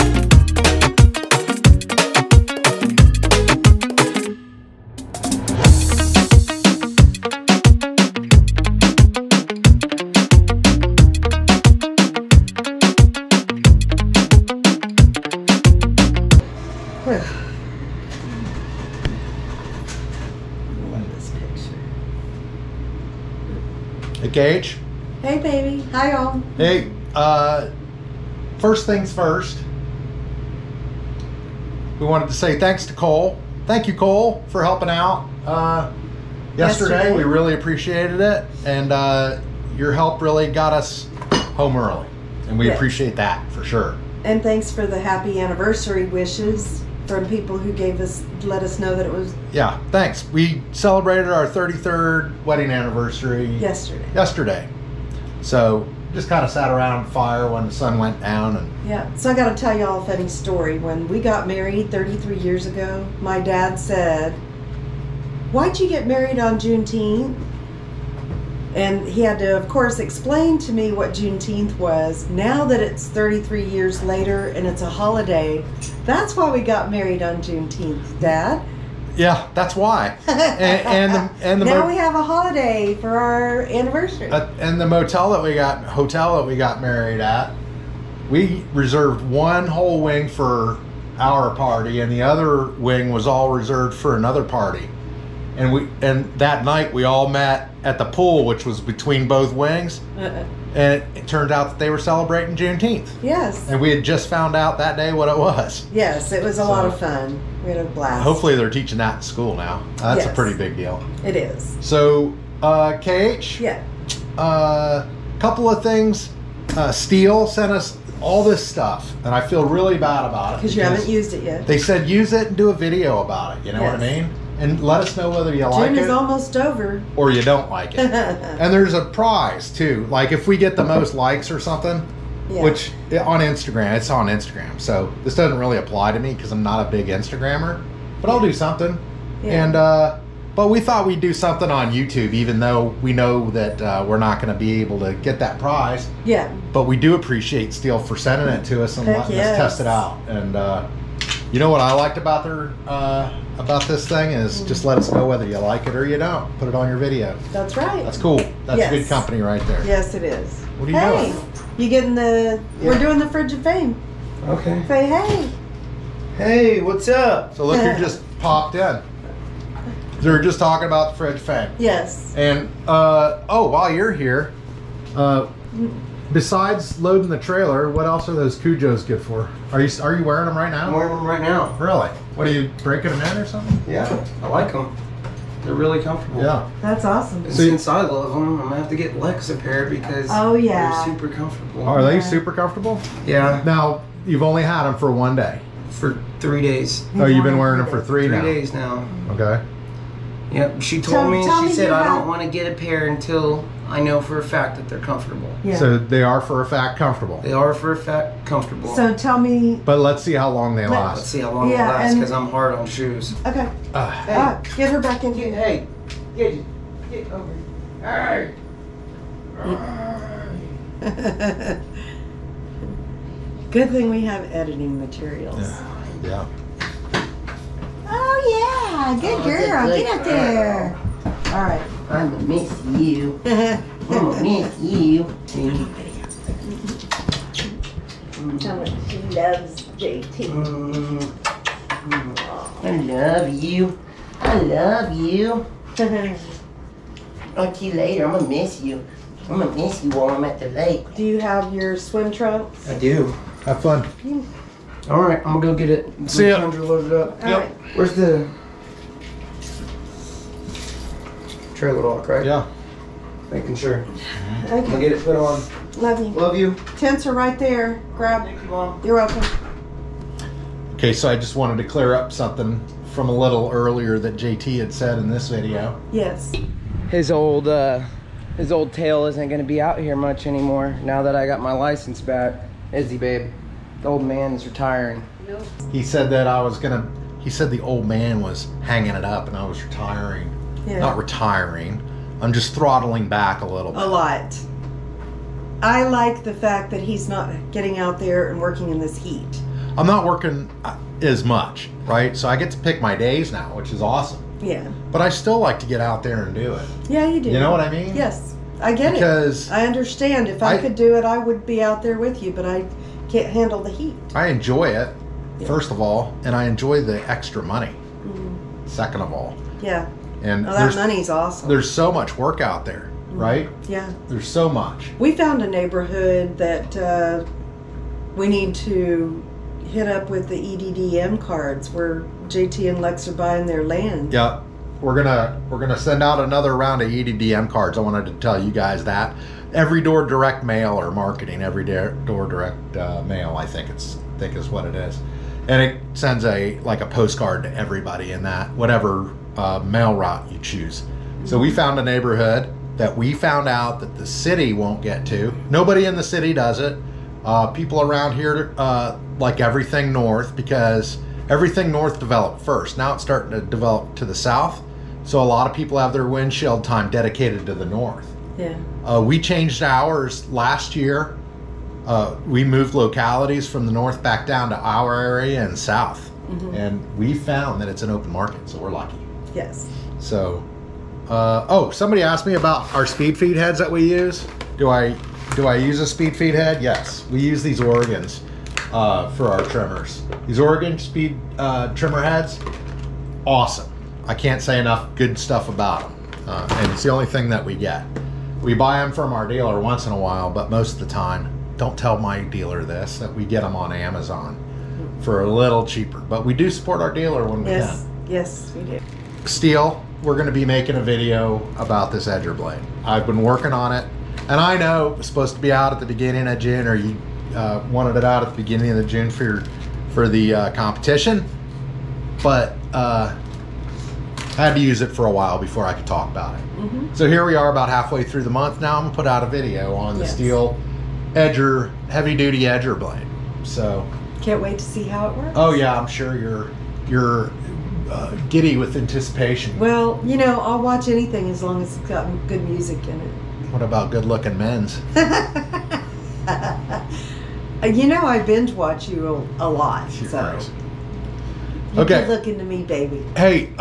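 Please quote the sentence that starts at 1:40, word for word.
and it, turned out that they were celebrating Juneteenth.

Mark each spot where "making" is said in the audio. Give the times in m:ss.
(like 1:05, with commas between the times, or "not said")
4:23, 6:50.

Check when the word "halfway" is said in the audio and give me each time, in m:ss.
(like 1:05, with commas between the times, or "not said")
7:07.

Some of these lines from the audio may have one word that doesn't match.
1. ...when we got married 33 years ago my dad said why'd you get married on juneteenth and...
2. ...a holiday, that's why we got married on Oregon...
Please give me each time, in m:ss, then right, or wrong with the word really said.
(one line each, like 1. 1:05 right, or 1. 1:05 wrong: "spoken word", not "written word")
1. 1:00 right
2. 1:14 wrong: "Juneteenth", not "Oregon".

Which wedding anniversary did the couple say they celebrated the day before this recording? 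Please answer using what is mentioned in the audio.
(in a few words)
33rd.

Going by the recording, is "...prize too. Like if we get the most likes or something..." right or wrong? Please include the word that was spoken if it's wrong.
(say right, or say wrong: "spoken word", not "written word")
right.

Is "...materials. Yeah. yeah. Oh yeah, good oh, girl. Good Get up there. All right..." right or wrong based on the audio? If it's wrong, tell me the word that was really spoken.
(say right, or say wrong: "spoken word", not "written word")
right.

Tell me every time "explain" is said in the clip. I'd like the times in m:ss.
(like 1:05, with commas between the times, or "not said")
1:09.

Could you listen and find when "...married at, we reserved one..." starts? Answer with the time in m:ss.
1:26.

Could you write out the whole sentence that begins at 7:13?
So can't wait to see how it works.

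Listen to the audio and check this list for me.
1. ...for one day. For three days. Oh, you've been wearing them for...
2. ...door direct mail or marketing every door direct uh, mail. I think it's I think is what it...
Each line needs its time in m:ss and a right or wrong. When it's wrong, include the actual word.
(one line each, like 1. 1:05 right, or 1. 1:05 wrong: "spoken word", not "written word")
1. 3:14 right
2. 5:39 right.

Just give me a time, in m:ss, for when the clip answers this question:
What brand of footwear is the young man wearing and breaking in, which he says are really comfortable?
2:58.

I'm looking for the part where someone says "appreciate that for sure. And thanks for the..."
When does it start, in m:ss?
0:42.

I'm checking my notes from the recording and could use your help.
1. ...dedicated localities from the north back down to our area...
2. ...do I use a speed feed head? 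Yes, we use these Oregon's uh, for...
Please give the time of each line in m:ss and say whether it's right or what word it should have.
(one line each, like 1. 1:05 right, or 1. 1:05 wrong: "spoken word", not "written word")
1. 6:12 wrong: "moved", not "dedicated"
2. 6:25 right.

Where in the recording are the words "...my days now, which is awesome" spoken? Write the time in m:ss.
5:03.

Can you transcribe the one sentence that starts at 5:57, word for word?
Uh, people around here uh, like everything north because everything north developed first.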